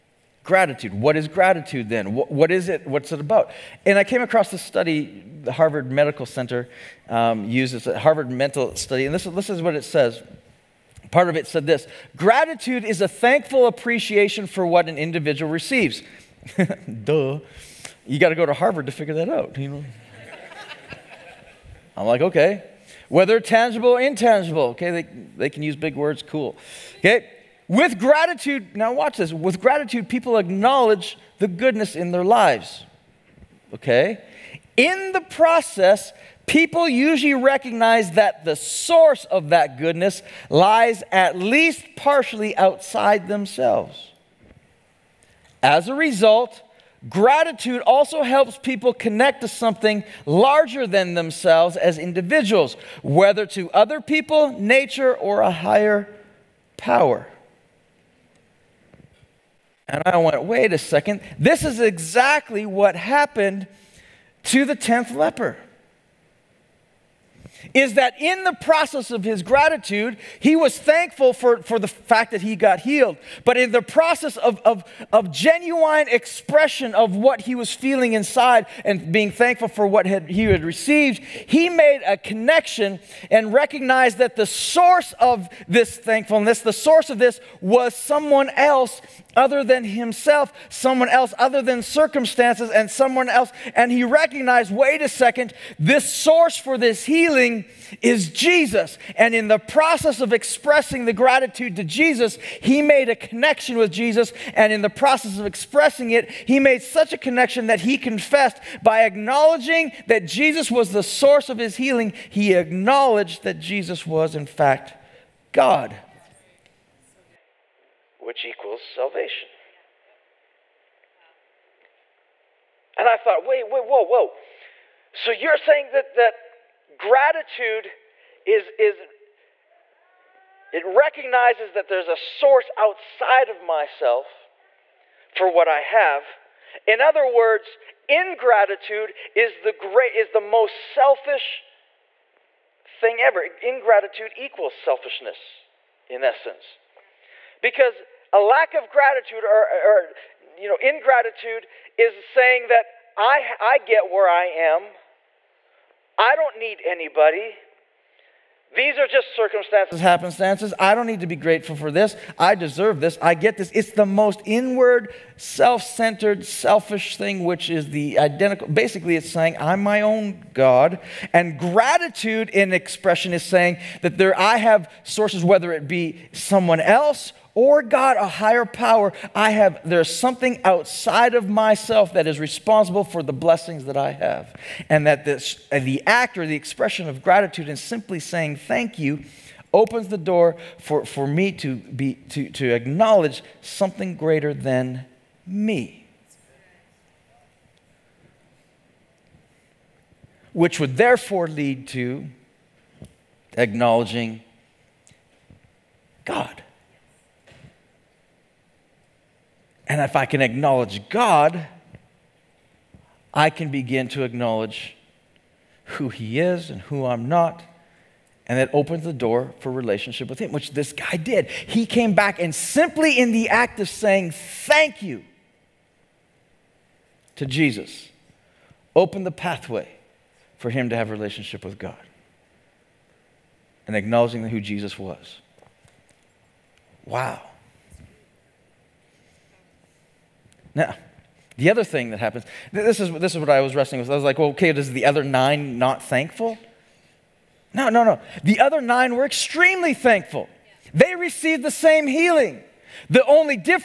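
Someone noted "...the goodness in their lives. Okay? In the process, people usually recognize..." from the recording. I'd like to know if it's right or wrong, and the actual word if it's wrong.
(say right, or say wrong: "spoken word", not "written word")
right.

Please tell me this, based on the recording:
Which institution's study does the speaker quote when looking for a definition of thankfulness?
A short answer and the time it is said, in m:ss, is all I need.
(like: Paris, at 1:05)
Harvard Medical Center, at 0:05.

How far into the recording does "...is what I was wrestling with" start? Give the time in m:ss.
4:03.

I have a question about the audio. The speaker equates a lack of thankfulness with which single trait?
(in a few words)
selfishness.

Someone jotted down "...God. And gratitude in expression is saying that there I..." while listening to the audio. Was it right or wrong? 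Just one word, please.
right.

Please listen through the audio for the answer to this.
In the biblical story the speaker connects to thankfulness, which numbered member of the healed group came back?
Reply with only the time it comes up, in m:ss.
1:04.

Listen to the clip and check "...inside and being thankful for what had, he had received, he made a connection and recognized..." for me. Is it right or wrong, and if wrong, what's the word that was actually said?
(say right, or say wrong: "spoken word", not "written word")
right.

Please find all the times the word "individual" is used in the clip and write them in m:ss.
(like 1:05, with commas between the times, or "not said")
0:14, 0:51.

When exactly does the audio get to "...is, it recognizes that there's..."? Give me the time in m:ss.
2:08.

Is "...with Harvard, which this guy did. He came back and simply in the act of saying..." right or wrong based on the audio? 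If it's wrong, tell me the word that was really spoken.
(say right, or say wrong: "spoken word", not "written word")
wrong: "Him", not "Harvard".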